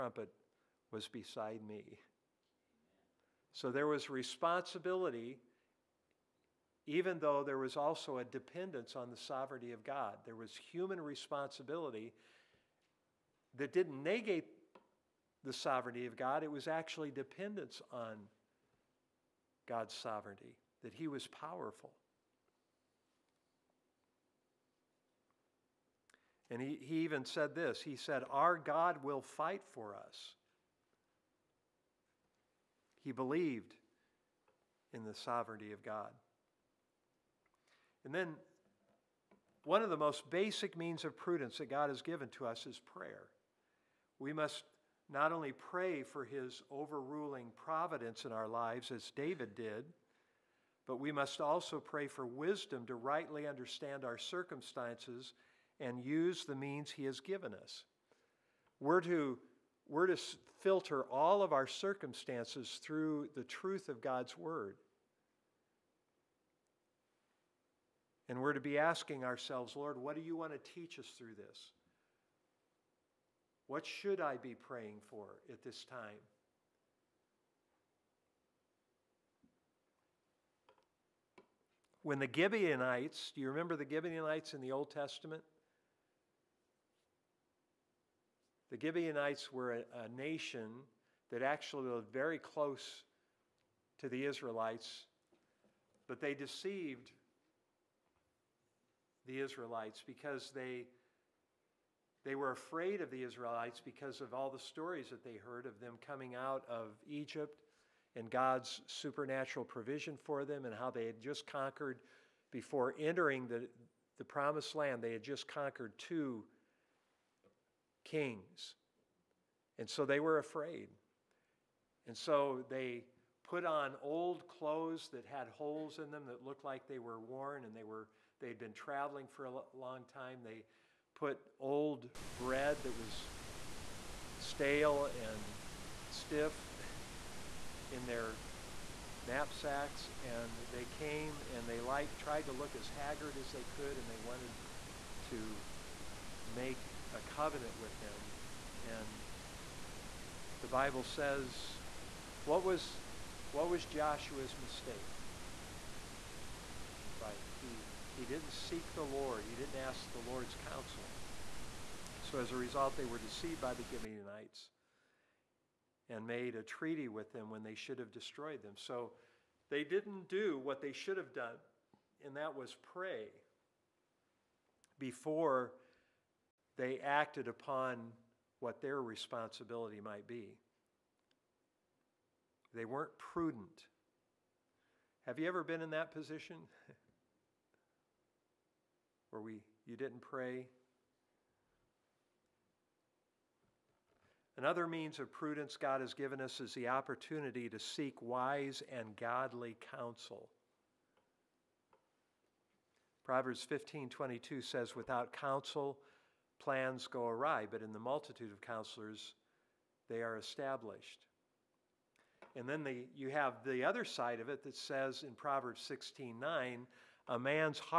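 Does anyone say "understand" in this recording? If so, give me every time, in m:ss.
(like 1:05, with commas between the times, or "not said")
0:53.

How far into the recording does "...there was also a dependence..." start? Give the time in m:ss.
0:07.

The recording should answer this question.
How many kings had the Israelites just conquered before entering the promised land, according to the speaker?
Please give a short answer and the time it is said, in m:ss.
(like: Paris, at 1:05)
2, at 1:55.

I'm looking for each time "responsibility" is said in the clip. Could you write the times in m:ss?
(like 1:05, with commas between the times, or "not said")
0:04, 0:11, 2:59.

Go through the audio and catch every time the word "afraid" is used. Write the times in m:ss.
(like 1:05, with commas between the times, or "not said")
1:42, 2:00.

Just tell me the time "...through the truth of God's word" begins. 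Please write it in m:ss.
1:02.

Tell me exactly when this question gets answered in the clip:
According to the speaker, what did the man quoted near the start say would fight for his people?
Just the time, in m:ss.
0:28.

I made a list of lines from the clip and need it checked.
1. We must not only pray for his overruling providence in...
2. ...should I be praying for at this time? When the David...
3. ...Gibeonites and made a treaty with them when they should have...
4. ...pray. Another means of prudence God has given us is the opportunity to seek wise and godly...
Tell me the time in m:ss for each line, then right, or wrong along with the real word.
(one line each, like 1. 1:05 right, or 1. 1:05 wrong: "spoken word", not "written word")
1. 0:44 right
2. 1:13 wrong: "Gibeonites", not "David"
3. 2:43 right
4. 3:10 right.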